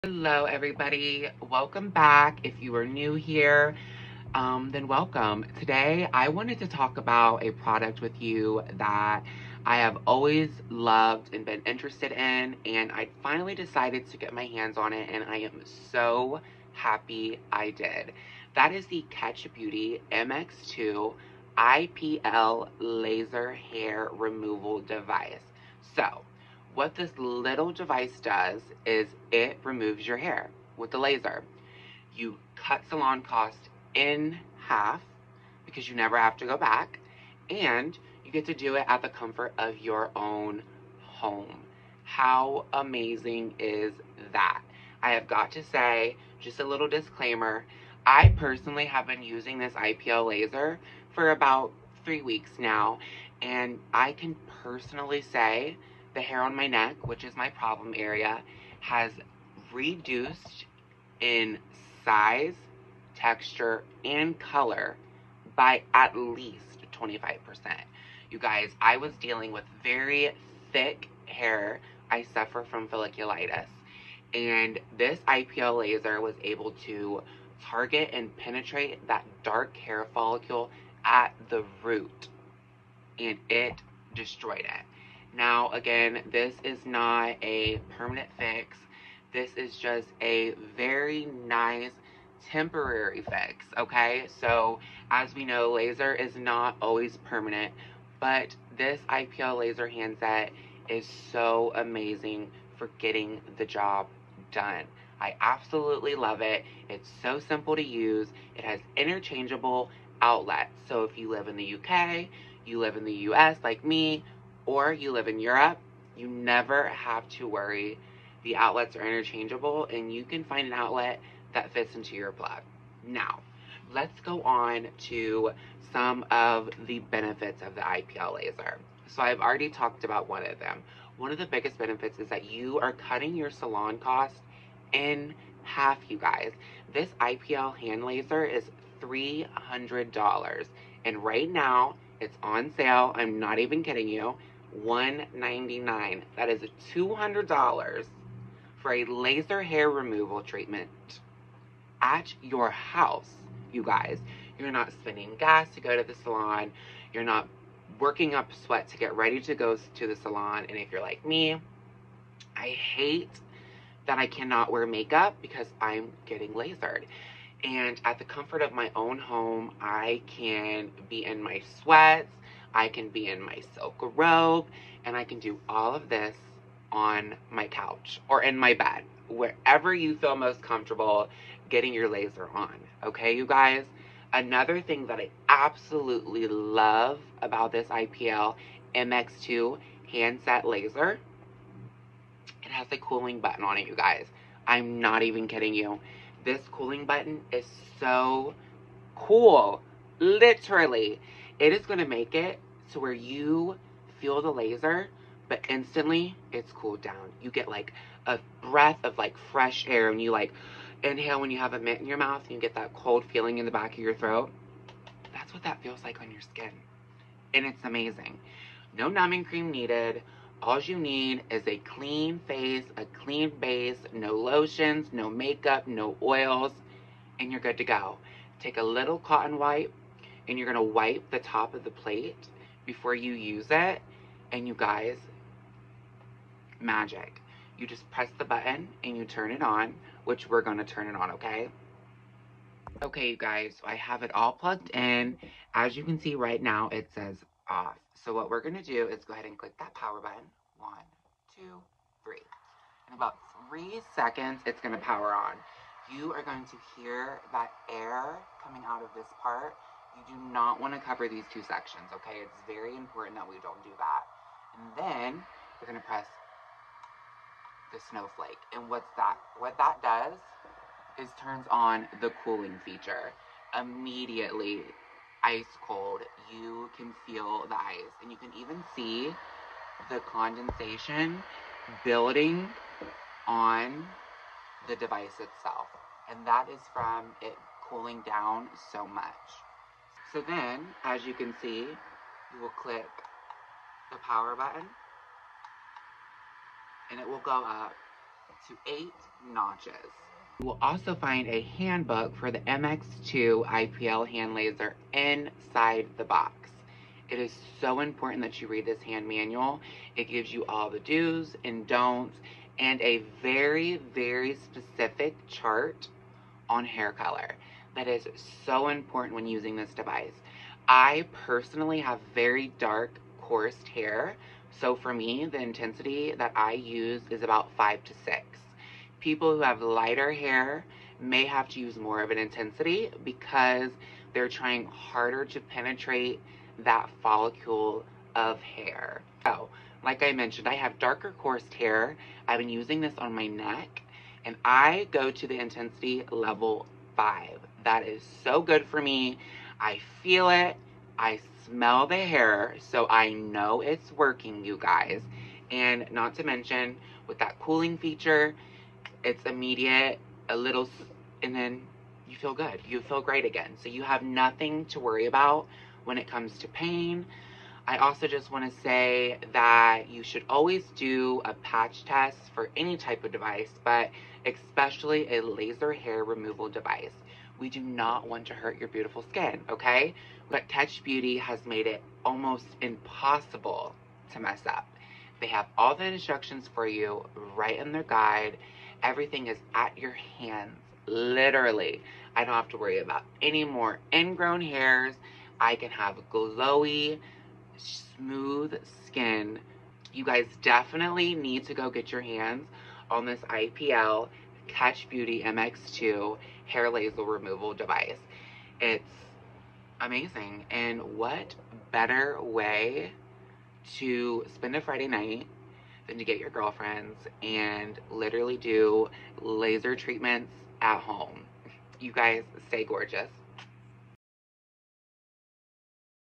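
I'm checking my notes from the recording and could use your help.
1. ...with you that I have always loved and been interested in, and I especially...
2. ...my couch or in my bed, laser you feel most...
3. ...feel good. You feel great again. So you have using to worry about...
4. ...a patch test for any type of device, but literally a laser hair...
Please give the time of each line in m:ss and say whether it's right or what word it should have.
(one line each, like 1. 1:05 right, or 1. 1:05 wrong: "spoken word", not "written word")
1. 0:08 wrong: "finally", not "especially"
2. 2:57 wrong: "wherever", not "laser"
3. 6:02 wrong: "nothing", not "using"
4. 6:11 wrong: "especially", not "literally".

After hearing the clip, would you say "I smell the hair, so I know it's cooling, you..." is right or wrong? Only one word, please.
wrong.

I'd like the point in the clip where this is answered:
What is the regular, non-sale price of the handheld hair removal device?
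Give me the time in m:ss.
2:19.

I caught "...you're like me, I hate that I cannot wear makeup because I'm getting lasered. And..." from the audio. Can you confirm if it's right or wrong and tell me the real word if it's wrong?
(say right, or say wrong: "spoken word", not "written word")
right.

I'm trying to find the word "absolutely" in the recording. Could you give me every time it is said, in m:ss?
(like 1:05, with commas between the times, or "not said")
1:45, 3:05.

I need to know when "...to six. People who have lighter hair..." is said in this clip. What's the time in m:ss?
5:28.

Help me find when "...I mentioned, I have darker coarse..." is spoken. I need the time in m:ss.
5:40.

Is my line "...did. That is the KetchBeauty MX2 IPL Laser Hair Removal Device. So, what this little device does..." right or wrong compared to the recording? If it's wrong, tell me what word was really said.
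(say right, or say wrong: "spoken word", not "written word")
right.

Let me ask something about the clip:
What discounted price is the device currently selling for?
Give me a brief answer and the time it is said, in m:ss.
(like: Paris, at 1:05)
$199, at 2:24.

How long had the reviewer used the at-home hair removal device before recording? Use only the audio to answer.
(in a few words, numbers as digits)
3 weeks.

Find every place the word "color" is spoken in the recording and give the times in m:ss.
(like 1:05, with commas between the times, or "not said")
1:04, 5:17.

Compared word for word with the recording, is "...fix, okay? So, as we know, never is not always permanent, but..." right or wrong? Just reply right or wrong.
wrong.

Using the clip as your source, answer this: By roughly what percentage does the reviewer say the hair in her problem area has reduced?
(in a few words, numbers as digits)
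25%.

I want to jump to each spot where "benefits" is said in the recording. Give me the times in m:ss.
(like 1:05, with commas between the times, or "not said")
2:06, 2:11.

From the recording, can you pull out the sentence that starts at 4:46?
And that is from it cooling down so much.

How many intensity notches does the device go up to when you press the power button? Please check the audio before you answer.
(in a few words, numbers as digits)
8.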